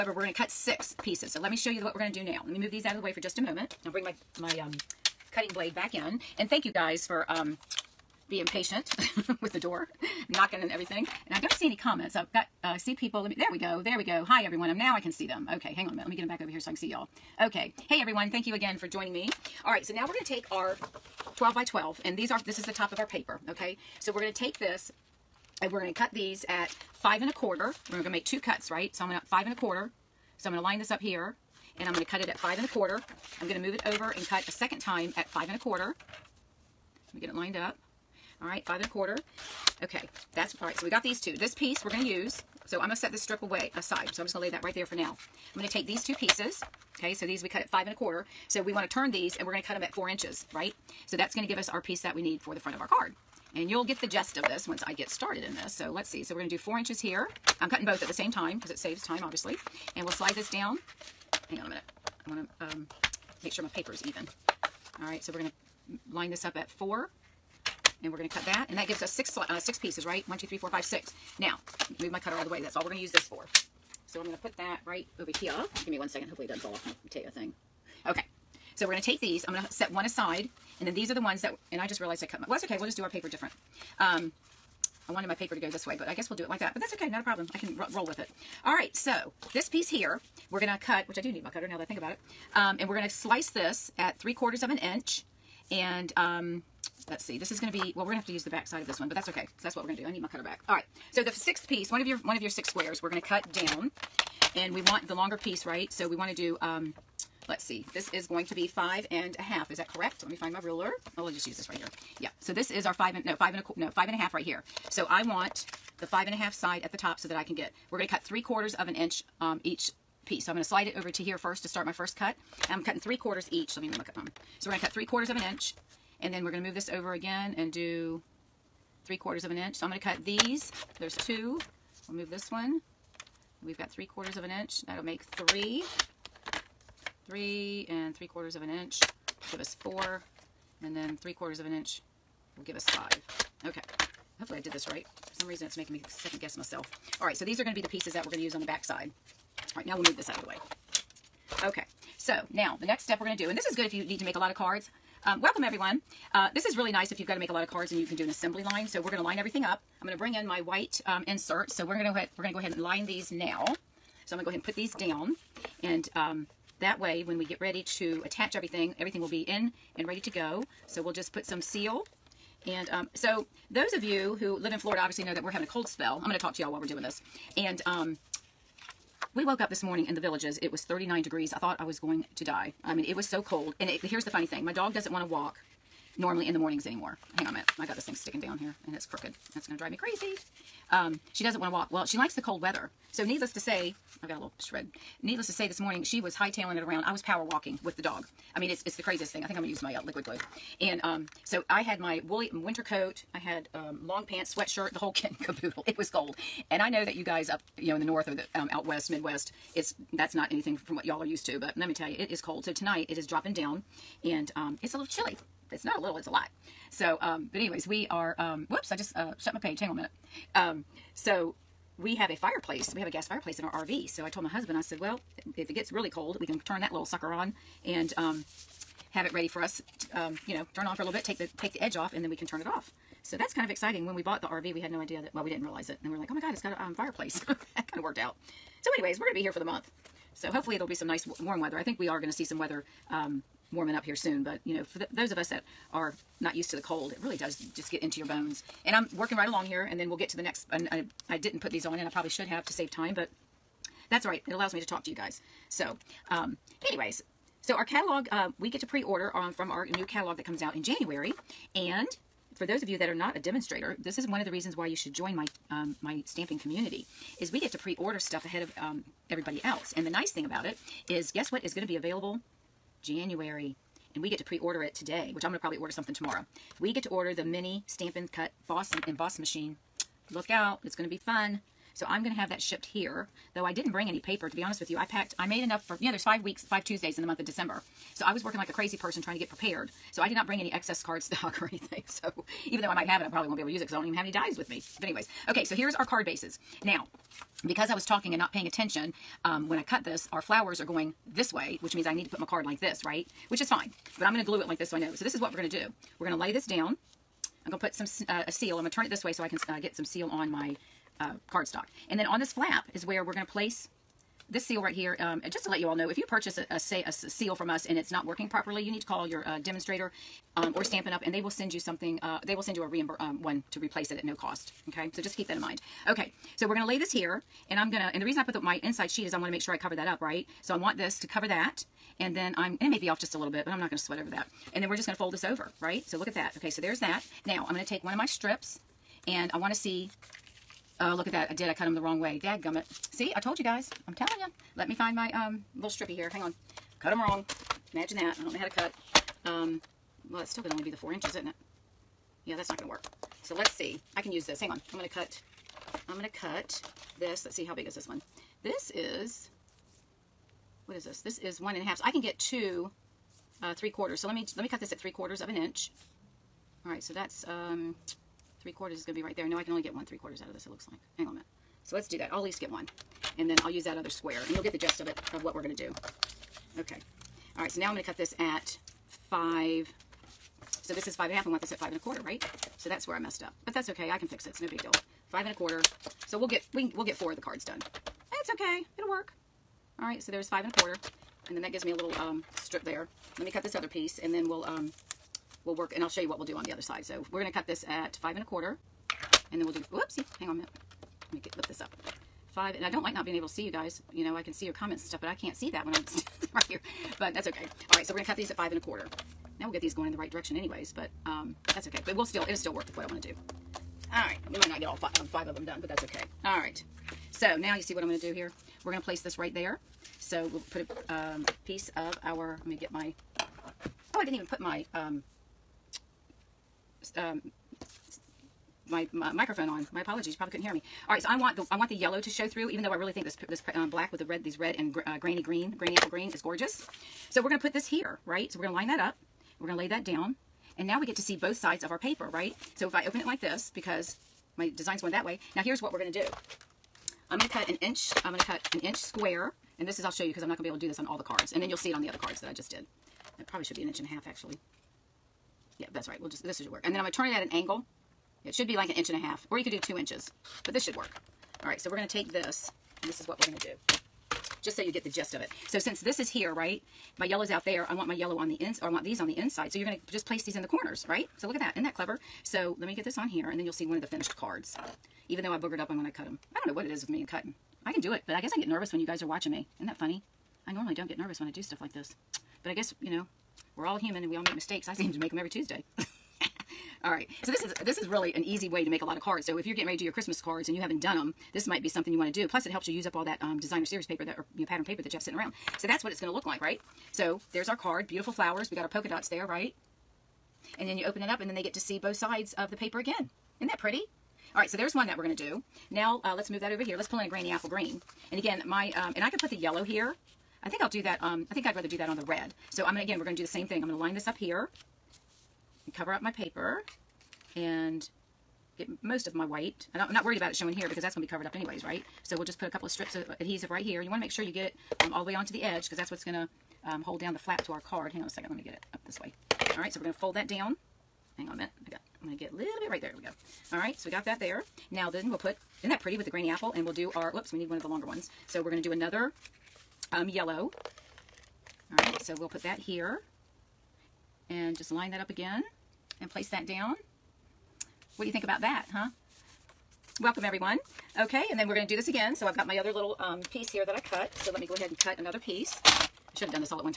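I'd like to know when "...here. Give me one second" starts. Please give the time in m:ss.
1:15.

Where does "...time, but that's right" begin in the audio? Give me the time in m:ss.
4:12.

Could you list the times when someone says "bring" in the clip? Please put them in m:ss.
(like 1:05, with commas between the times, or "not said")
0:03, 2:40, 4:43, 4:50.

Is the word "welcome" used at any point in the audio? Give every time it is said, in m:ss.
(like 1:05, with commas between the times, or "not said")
2:35, 9:10.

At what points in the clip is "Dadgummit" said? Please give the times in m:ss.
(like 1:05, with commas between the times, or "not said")
5:42.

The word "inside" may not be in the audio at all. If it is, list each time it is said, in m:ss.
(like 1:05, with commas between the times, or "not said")
5:28, 7:49.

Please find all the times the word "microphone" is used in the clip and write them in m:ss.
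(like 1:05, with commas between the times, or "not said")
7:09.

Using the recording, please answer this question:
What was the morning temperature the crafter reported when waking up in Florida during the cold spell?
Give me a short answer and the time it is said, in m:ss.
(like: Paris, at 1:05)
39 degrees, at 3:00.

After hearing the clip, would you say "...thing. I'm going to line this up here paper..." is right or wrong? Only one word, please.
wrong.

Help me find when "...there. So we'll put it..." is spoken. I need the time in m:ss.
6:59.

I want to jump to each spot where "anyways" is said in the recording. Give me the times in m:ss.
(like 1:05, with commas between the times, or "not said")
3:37, 3:58, 4:16, 4:55, 6:50, 8:41.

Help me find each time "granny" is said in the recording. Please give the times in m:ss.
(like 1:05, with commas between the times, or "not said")
7:15, 8:27, 8:56.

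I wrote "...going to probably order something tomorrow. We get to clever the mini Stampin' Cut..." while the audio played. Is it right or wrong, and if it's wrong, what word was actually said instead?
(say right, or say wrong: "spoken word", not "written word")
wrong: "order", not "clever".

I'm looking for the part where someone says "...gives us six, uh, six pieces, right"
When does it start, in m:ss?
1:08.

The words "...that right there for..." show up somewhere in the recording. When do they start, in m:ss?
0:44.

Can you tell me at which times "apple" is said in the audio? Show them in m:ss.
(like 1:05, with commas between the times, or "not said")
7:15, 8:27, 8:56.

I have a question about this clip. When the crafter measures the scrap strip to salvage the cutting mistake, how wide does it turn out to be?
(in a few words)
1 and a half inches.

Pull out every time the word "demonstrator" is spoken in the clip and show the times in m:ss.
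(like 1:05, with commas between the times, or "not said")
4:23, 5:19.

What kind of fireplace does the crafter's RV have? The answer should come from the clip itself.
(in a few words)
gas fireplace.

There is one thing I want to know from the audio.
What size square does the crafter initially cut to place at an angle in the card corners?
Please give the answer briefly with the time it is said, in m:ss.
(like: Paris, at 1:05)
1 inch, at 7:28.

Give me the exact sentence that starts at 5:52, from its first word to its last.
Yeah, that's not going to work.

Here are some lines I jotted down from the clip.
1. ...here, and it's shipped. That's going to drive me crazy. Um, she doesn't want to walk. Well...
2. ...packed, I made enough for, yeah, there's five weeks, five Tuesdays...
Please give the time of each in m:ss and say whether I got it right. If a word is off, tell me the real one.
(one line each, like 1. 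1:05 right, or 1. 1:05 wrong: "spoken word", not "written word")
1. 3:08 wrong: "crooked", not "shipped"
2. 4:45 right.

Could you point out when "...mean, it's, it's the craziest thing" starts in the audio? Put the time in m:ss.
3:18.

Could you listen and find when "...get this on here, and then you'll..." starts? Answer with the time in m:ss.
7:52.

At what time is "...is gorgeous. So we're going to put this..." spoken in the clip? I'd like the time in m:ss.
7:16.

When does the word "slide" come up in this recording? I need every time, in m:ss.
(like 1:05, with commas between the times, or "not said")
1:00, 2:00.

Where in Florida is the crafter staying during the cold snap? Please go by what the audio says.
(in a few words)
The Villages.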